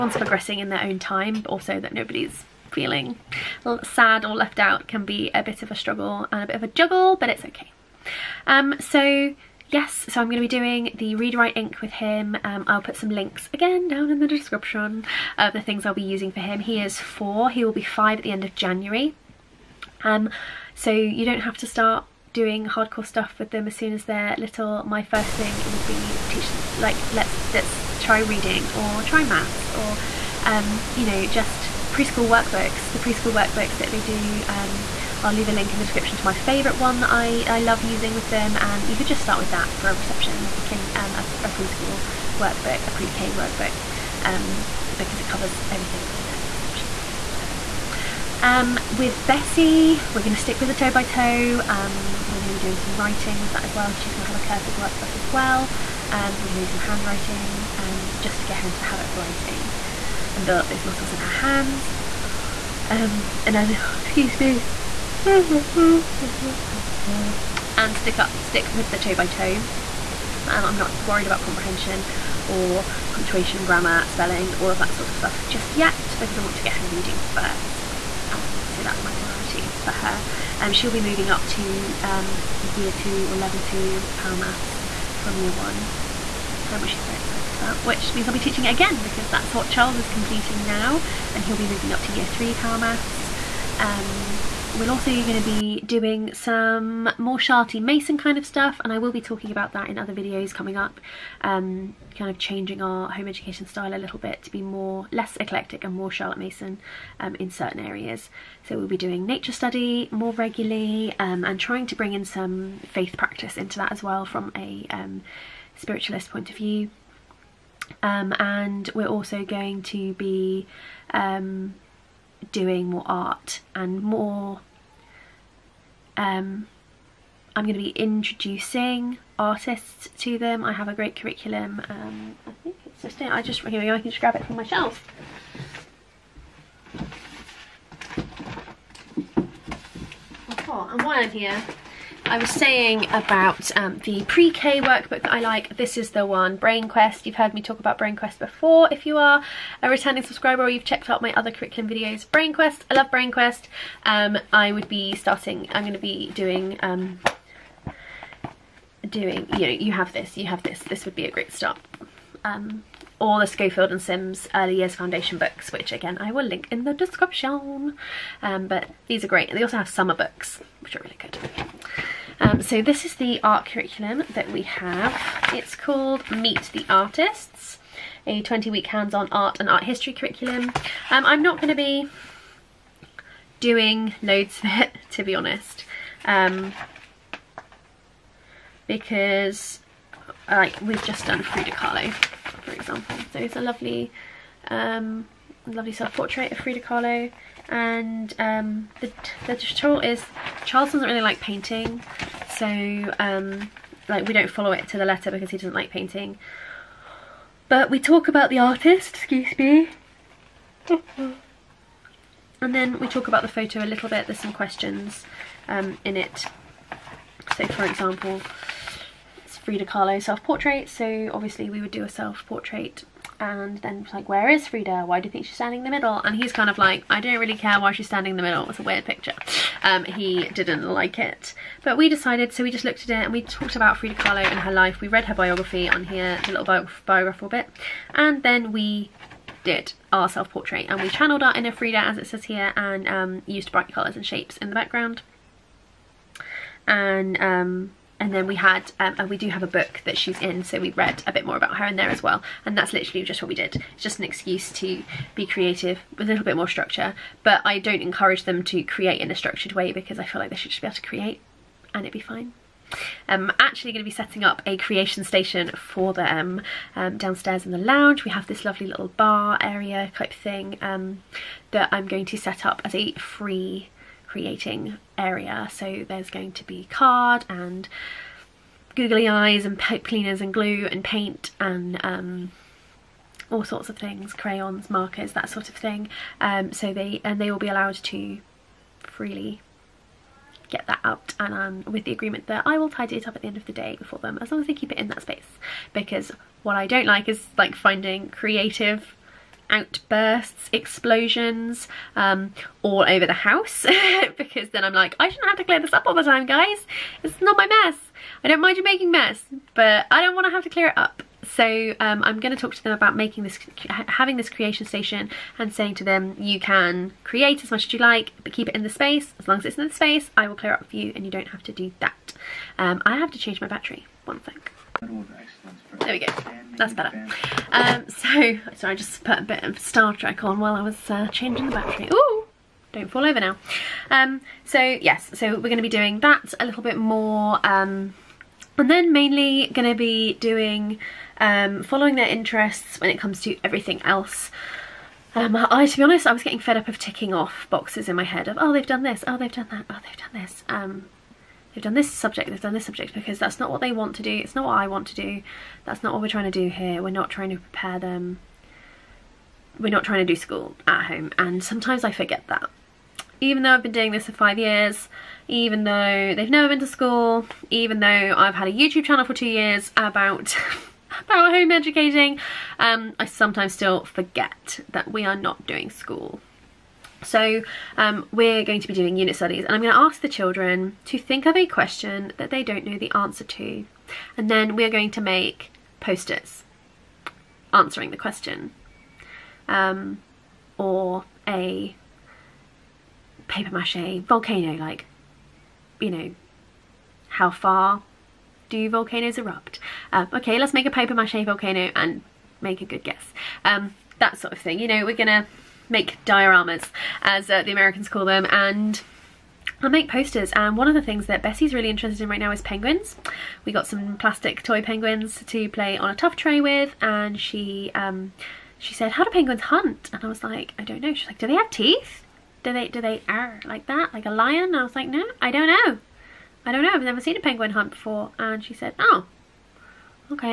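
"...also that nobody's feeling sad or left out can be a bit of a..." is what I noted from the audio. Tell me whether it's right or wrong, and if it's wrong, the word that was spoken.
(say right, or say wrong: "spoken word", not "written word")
right.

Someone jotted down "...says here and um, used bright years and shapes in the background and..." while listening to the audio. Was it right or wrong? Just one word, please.
wrong.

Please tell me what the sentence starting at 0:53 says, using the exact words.
She's going to have a cursive workbook as well.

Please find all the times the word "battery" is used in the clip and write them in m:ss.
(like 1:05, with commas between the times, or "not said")
5:23, 5:31.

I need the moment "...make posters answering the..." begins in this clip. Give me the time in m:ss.
6:25.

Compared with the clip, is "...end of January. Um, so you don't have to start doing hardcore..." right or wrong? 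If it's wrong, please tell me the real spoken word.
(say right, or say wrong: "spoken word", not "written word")
right.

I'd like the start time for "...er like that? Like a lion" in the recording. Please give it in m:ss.
7:03.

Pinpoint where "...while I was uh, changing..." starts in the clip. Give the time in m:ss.
5:30.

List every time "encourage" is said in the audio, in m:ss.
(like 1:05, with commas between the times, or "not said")
4:18.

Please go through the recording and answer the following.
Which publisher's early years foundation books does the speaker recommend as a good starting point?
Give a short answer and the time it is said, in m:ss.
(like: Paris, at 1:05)
Schofield and Sims, at 2:43.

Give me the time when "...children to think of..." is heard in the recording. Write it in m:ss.
6:20.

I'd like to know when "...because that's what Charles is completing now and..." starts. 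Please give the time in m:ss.
1:29.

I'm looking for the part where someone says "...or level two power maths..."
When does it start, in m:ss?
1:23.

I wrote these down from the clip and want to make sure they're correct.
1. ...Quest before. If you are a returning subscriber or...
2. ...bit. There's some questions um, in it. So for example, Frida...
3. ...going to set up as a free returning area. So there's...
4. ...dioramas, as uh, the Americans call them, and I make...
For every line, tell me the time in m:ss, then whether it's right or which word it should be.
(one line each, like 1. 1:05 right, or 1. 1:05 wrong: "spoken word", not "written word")
1. 2:28 right
2. 3:34 right
3. 4:32 wrong: "creating", not "returning"
4. 6:46 right.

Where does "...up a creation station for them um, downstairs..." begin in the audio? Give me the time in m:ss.
4:24.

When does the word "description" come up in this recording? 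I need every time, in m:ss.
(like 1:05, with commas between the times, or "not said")
0:14, 0:35, 2:46.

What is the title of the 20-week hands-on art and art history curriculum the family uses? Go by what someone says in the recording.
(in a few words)
Meet the Artists.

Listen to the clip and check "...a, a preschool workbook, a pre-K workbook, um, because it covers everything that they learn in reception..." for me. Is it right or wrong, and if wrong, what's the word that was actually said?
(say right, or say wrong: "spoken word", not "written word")
right.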